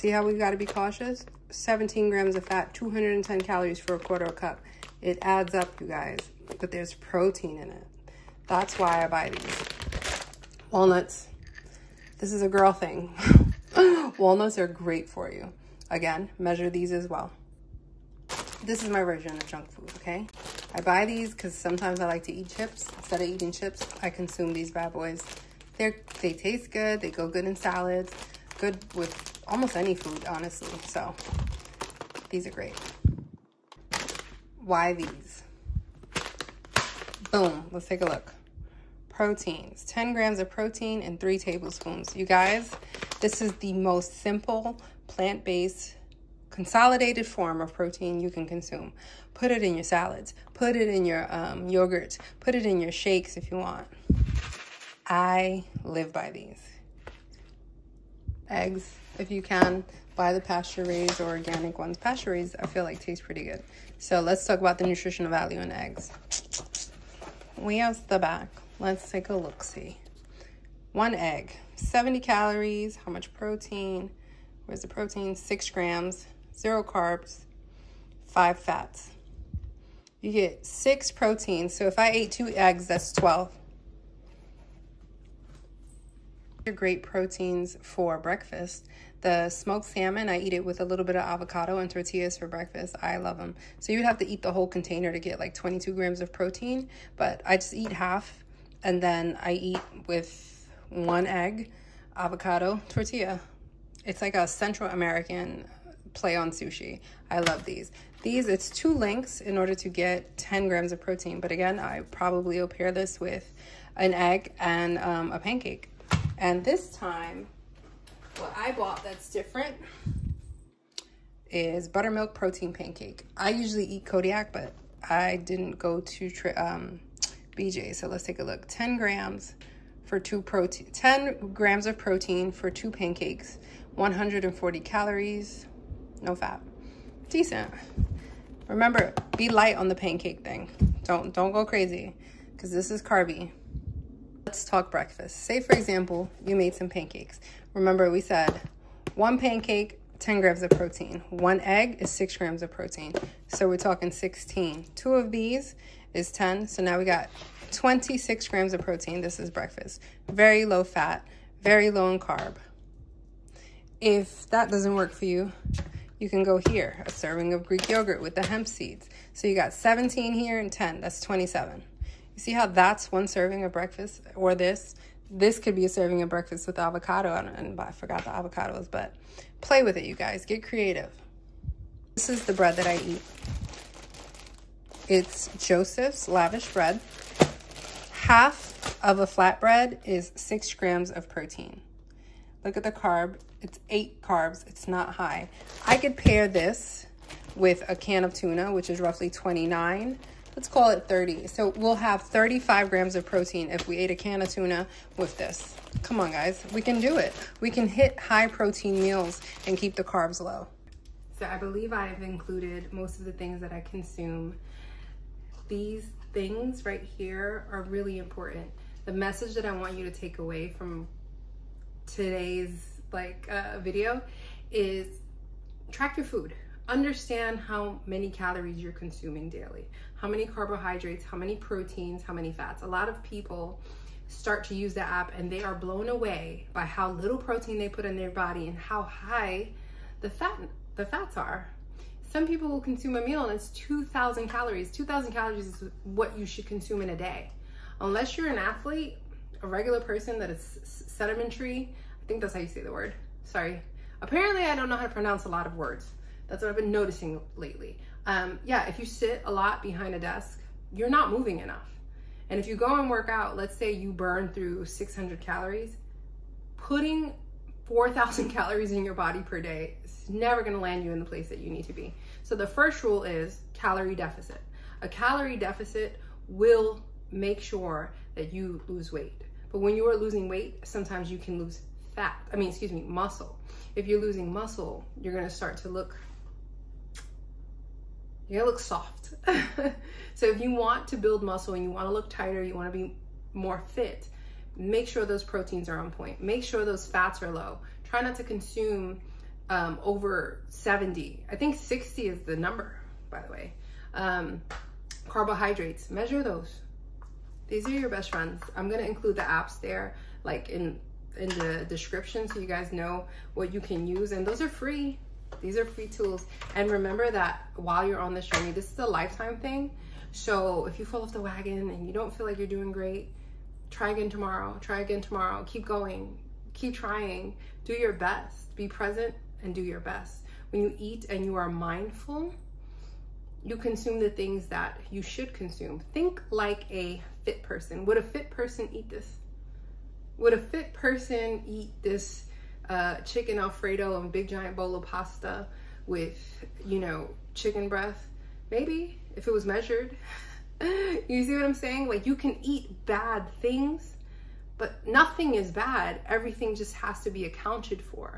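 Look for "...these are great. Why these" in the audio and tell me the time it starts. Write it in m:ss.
0:32.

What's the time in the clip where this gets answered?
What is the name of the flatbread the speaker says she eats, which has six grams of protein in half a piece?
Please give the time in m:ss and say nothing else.
3:05.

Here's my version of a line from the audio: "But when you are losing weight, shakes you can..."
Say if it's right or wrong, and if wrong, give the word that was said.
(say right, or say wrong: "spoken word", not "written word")
wrong: "sometimes", not "shakes".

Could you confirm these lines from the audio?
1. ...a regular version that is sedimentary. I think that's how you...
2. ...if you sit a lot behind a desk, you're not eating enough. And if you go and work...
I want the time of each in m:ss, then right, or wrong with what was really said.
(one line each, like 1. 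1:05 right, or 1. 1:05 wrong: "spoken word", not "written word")
1. 4:09 wrong: "person", not "version"
2. 4:18 wrong: "moving", not "eating".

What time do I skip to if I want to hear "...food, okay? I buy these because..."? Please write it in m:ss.
0:19.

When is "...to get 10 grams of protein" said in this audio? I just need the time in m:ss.
1:49.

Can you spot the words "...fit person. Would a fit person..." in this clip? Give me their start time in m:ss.
5:37.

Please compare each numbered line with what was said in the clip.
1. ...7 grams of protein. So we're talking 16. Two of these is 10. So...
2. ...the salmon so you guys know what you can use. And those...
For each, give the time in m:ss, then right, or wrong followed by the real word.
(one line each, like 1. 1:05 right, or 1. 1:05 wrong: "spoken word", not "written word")
1. 2:32 wrong: "6", not "7"
2. 5:11 wrong: "description", not "salmon".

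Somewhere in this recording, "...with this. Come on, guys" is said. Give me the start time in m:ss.
3:25.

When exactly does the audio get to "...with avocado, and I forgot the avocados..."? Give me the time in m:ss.
2:56.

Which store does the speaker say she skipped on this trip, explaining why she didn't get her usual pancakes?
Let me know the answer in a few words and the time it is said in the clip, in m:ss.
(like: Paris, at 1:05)
BJ, at 2:07.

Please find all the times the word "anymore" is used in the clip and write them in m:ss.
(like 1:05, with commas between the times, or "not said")
not said.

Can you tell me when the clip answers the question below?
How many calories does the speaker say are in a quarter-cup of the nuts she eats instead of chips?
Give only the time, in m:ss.
0:02.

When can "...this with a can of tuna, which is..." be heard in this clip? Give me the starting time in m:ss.
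3:16.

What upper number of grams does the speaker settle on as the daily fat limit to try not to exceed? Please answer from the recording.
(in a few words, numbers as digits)
60.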